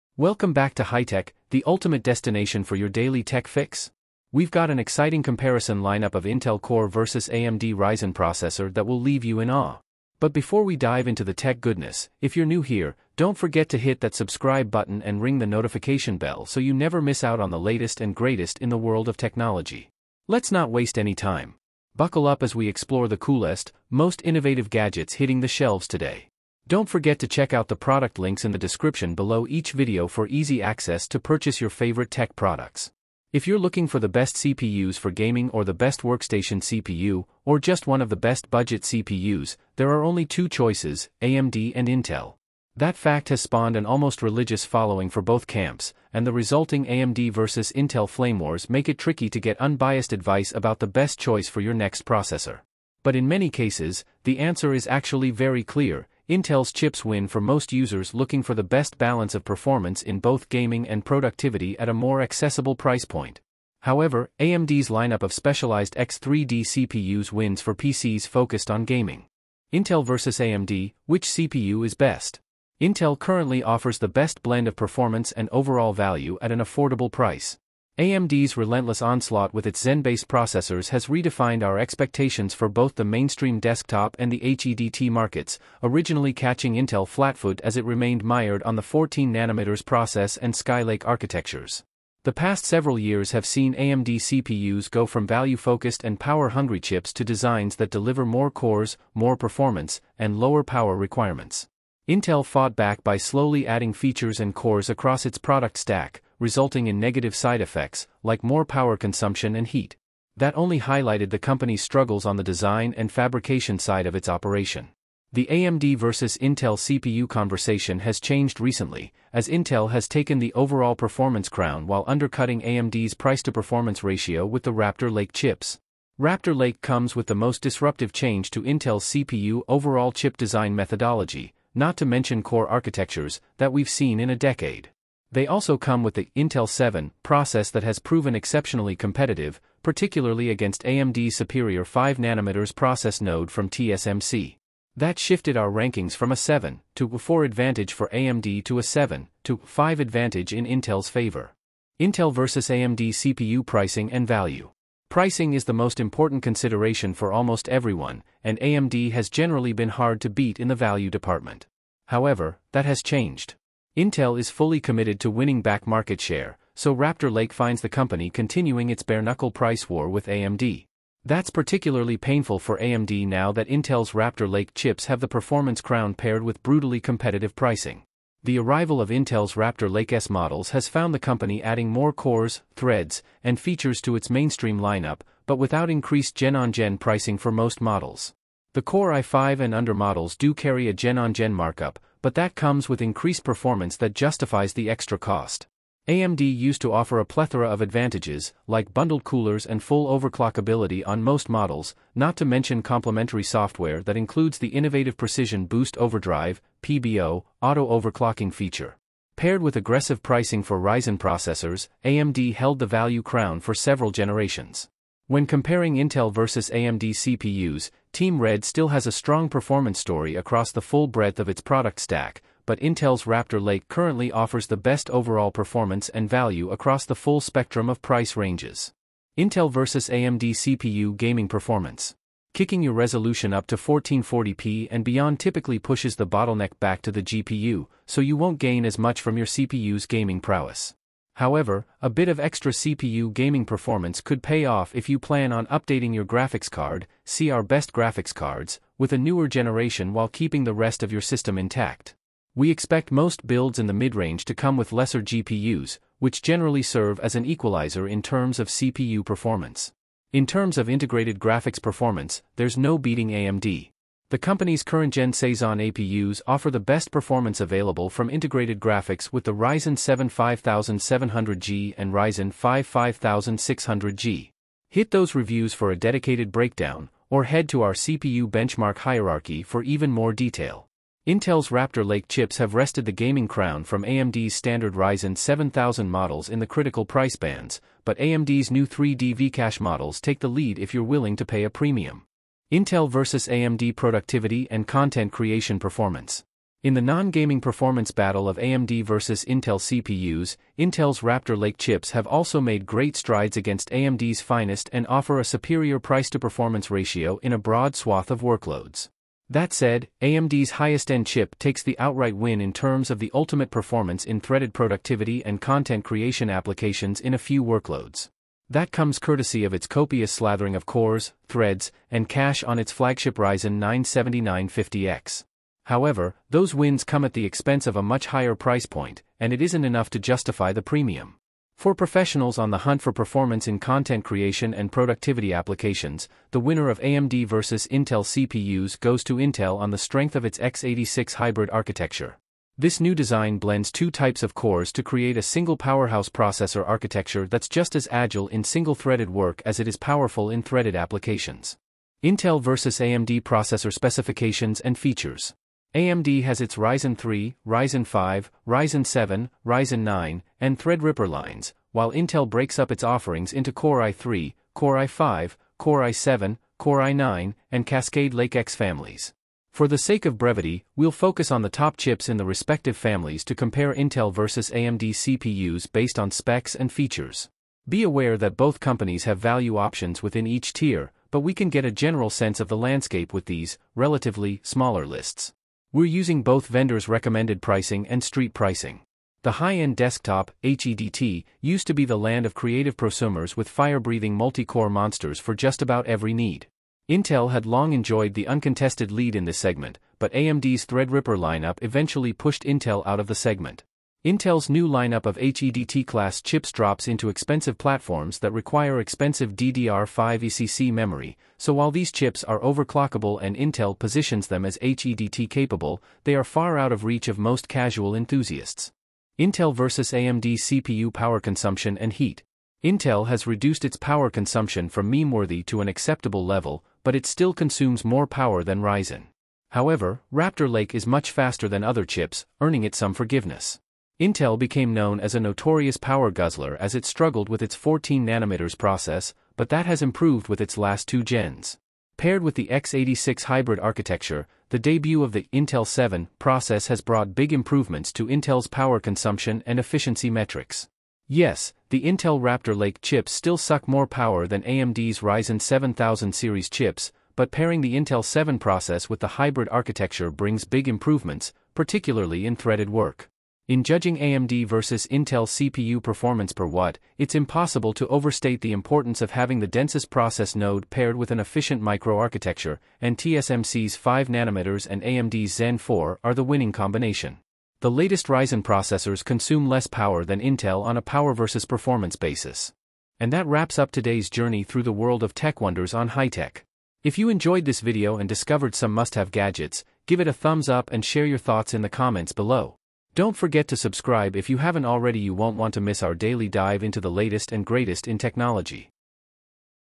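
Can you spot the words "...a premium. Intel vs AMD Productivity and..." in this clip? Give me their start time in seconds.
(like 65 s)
291 s.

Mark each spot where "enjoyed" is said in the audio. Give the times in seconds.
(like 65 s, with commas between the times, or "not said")
397 s, 487 s.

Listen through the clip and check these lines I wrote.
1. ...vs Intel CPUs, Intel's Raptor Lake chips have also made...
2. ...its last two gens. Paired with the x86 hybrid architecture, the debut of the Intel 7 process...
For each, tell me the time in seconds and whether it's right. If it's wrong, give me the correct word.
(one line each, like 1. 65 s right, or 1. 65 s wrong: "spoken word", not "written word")
1. 299 s right
2. 440 s right.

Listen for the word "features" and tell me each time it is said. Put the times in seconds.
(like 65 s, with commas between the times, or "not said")
103 s, 183 s, 208 s, 354 s, 376 s.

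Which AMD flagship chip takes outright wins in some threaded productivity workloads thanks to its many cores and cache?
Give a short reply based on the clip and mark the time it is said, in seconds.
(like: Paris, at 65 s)
Ryzen 9 7950X, at 323 s.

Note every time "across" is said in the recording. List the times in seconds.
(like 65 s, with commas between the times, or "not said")
104 s, 220 s, 226 s.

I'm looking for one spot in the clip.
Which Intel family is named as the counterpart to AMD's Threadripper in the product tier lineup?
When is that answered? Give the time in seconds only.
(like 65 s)
367 s.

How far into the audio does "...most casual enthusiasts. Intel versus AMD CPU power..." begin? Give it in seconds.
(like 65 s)
417 s.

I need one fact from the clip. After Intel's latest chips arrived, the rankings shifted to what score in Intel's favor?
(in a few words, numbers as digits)
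7 to 5.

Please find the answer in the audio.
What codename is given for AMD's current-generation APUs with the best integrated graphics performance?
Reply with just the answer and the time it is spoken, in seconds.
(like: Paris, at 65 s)
Cezanne, at 265 s.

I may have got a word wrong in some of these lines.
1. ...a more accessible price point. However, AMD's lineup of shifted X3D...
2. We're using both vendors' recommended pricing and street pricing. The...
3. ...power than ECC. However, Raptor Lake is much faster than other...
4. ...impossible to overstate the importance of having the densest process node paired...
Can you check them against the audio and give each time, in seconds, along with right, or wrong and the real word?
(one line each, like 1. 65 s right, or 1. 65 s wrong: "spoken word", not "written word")
1. 61 s wrong: "specialized", not "shifted"
2. 385 s right
3. 428 s wrong: "Ryzen", not "ECC"
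4. 467 s right.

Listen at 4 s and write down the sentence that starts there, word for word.
We've got an exciting comparison lineup of Intel Core versus AMD Ryzen processor that will leave you in awe.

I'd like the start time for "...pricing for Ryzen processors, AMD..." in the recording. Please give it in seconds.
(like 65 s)
210 s.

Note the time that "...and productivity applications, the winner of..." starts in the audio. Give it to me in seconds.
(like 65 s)
334 s.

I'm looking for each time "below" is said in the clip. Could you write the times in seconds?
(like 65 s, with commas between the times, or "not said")
29 s, 492 s.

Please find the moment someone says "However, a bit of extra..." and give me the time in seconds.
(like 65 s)
241 s.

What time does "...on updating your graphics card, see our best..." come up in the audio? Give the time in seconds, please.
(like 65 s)
245 s.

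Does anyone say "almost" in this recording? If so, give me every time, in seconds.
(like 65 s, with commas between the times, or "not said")
43 s, 157 s.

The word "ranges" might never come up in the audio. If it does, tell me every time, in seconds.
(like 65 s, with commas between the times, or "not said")
228 s, 253 s.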